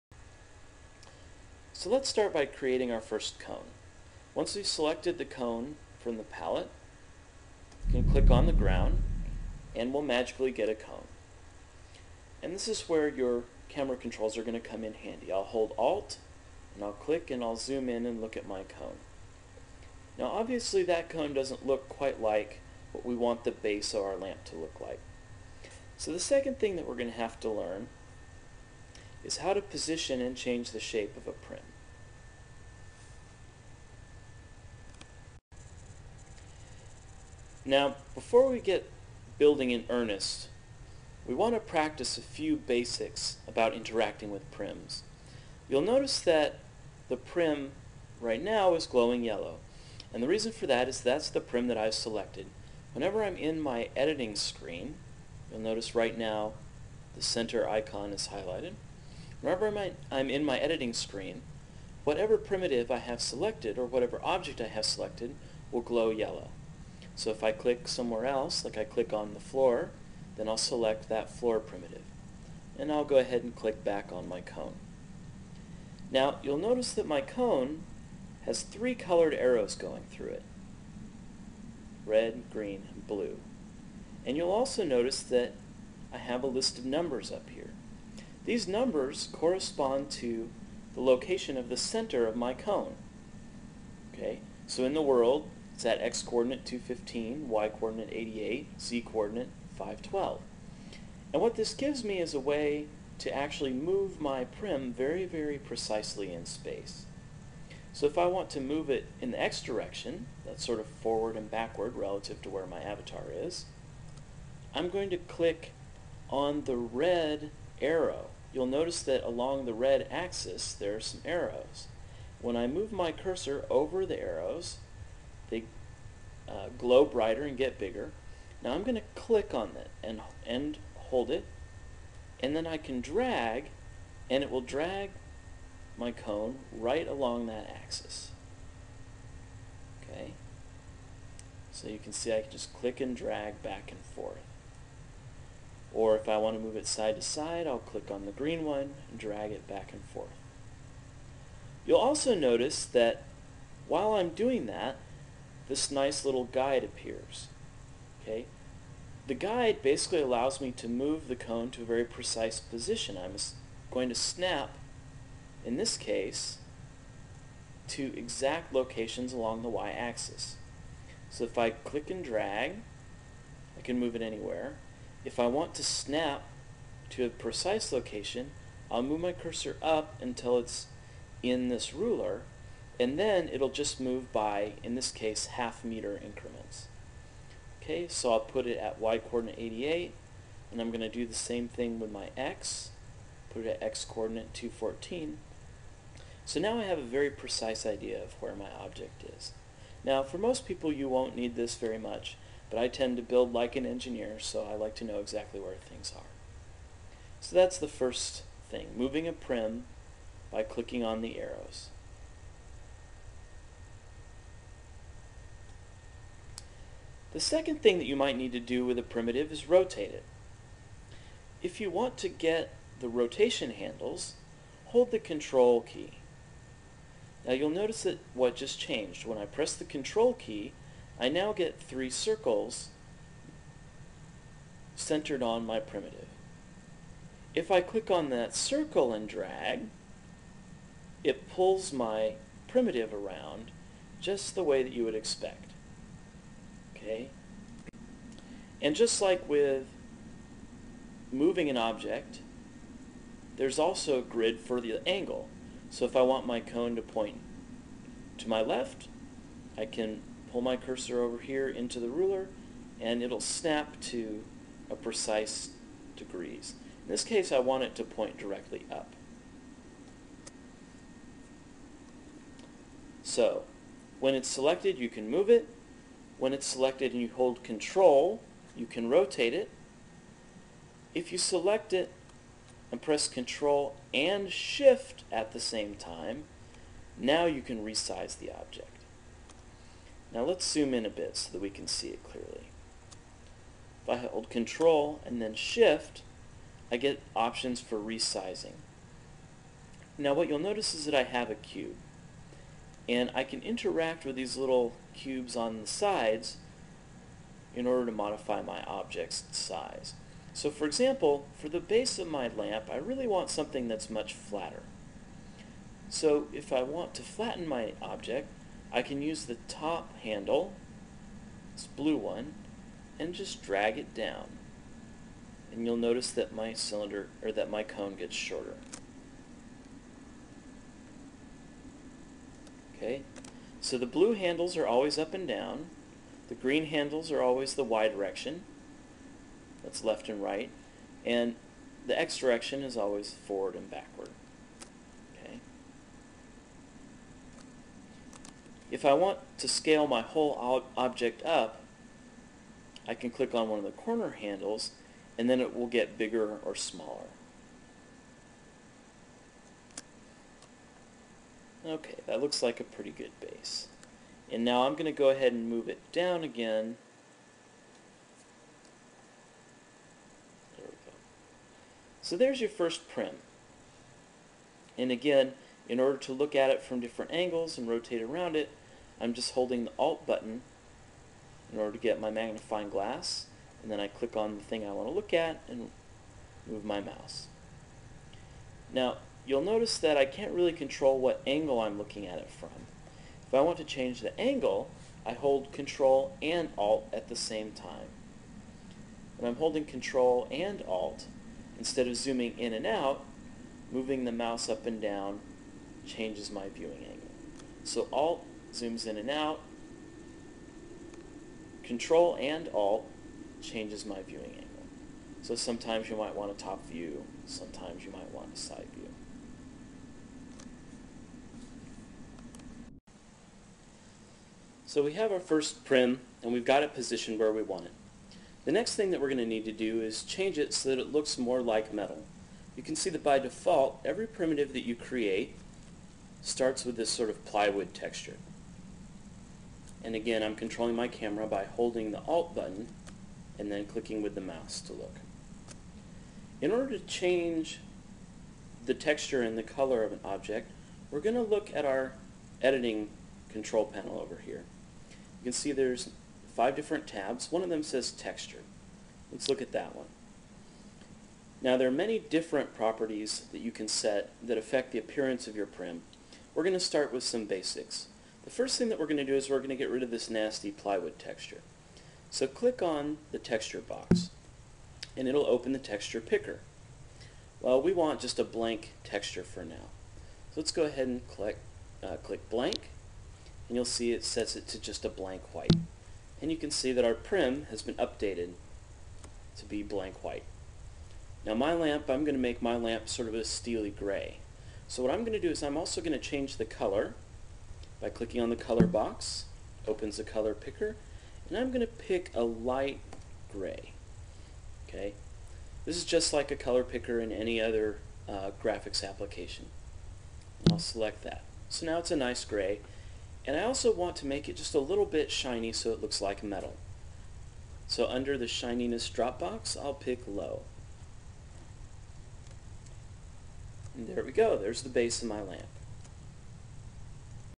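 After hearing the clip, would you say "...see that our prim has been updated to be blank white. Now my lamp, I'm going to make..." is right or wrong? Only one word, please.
right.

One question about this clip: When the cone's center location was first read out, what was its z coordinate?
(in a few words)
512.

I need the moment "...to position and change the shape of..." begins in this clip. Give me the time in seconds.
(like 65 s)
29 s.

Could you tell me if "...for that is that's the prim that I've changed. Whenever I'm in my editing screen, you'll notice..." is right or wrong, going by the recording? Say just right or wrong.
wrong.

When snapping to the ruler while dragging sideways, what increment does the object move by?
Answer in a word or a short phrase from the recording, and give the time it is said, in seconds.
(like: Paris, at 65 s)
Half meter, at 185 s.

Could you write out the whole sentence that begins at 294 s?
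If I hold control and then shift, I get options for resizing.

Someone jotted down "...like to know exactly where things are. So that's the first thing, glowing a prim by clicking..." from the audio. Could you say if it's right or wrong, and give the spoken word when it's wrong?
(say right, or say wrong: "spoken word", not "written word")
wrong: "moving", not "glowing".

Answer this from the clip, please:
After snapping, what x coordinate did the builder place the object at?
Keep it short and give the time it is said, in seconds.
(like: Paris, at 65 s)
214, at 194 s.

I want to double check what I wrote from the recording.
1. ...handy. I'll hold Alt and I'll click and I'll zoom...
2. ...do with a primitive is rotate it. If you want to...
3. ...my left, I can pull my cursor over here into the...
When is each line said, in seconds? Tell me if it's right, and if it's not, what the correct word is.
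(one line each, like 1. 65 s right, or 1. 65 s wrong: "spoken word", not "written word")
1. 14 s right
2. 218 s right
3. 258 s right.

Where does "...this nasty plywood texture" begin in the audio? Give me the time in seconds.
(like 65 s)
470 s.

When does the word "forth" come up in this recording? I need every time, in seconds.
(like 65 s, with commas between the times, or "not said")
144 s, 150 s.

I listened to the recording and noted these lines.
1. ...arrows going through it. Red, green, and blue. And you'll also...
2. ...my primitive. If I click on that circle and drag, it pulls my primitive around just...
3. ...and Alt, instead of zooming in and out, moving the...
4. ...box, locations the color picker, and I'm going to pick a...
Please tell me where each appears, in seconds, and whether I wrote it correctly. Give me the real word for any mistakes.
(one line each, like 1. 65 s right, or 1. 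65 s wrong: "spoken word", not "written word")
1. 79 s right
2. 235 s right
3. 400 s right
4. 498 s wrong: "opens", not "locations".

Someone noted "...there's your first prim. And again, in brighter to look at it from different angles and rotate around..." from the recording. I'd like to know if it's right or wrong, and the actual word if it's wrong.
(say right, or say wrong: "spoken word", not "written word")
wrong: "order", not "brighter".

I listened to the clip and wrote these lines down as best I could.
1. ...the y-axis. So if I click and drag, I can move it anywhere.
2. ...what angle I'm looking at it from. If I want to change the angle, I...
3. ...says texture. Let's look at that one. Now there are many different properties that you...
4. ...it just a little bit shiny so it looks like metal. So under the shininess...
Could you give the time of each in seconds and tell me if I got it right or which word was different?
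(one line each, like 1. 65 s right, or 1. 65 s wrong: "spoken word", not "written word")
1. 169 s right
2. 391 s right
3. 457 s right
4. 514 s right.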